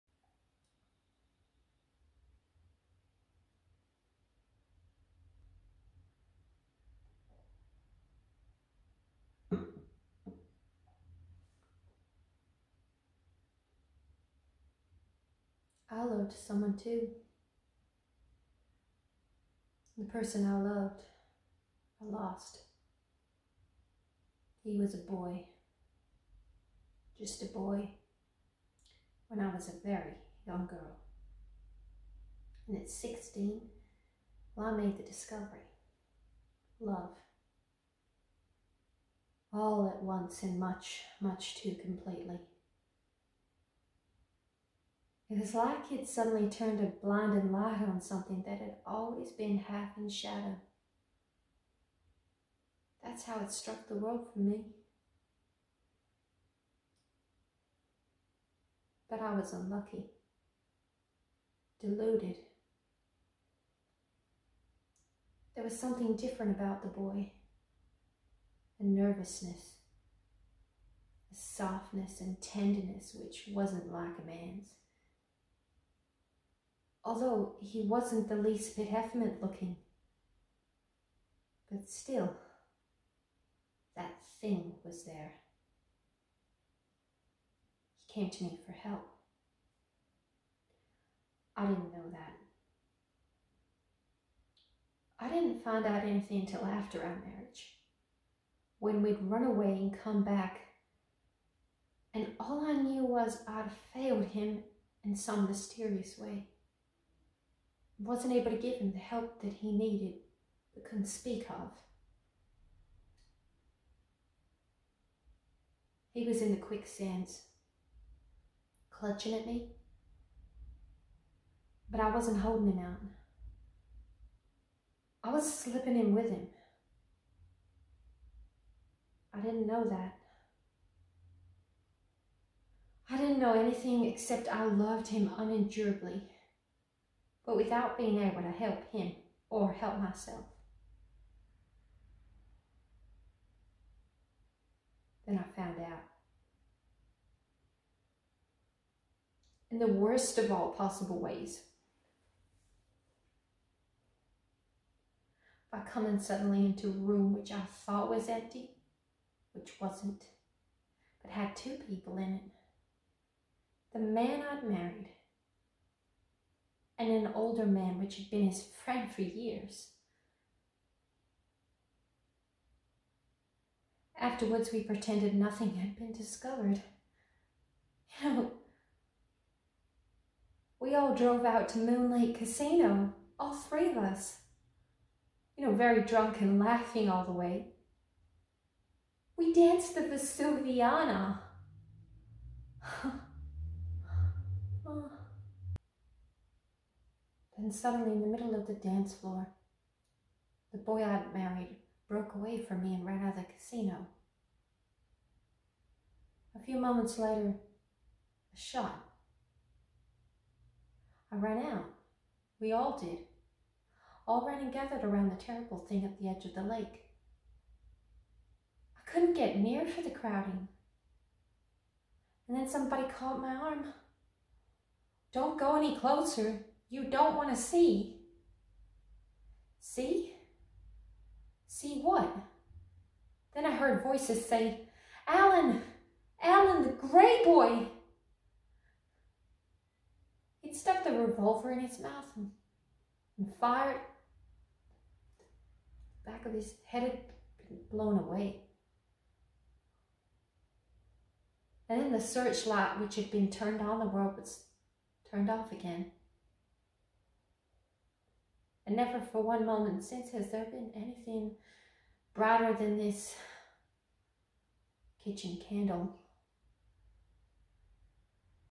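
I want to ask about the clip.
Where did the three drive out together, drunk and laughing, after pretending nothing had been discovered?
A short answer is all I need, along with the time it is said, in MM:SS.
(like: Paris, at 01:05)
Moon Lake Casino, at 03:01.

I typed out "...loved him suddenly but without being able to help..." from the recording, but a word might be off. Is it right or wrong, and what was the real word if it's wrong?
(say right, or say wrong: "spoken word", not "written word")
wrong: "unendurably", not "suddenly".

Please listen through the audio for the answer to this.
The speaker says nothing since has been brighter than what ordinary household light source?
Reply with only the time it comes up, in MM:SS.
04:25.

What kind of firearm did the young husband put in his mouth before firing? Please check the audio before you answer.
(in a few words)
Revolver.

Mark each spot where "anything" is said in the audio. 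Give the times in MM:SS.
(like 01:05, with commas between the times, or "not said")
01:36, 02:13, 04:20.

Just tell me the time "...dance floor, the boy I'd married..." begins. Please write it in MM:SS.
03:18.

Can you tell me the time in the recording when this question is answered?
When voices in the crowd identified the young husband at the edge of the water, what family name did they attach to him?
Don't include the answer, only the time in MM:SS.
03:56.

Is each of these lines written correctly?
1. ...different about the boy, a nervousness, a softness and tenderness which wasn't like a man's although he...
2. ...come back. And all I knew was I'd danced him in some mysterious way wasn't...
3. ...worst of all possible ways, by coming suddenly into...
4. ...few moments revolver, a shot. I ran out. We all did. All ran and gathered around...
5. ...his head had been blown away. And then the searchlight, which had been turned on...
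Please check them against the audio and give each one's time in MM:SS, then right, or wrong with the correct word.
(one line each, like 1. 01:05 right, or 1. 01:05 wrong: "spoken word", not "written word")
1. 01:06 right
2. 01:40 wrong: "failed", not "danced"
3. 02:29 right
4. 03:26 wrong: "later", not "revolver"
5. 04:06 right.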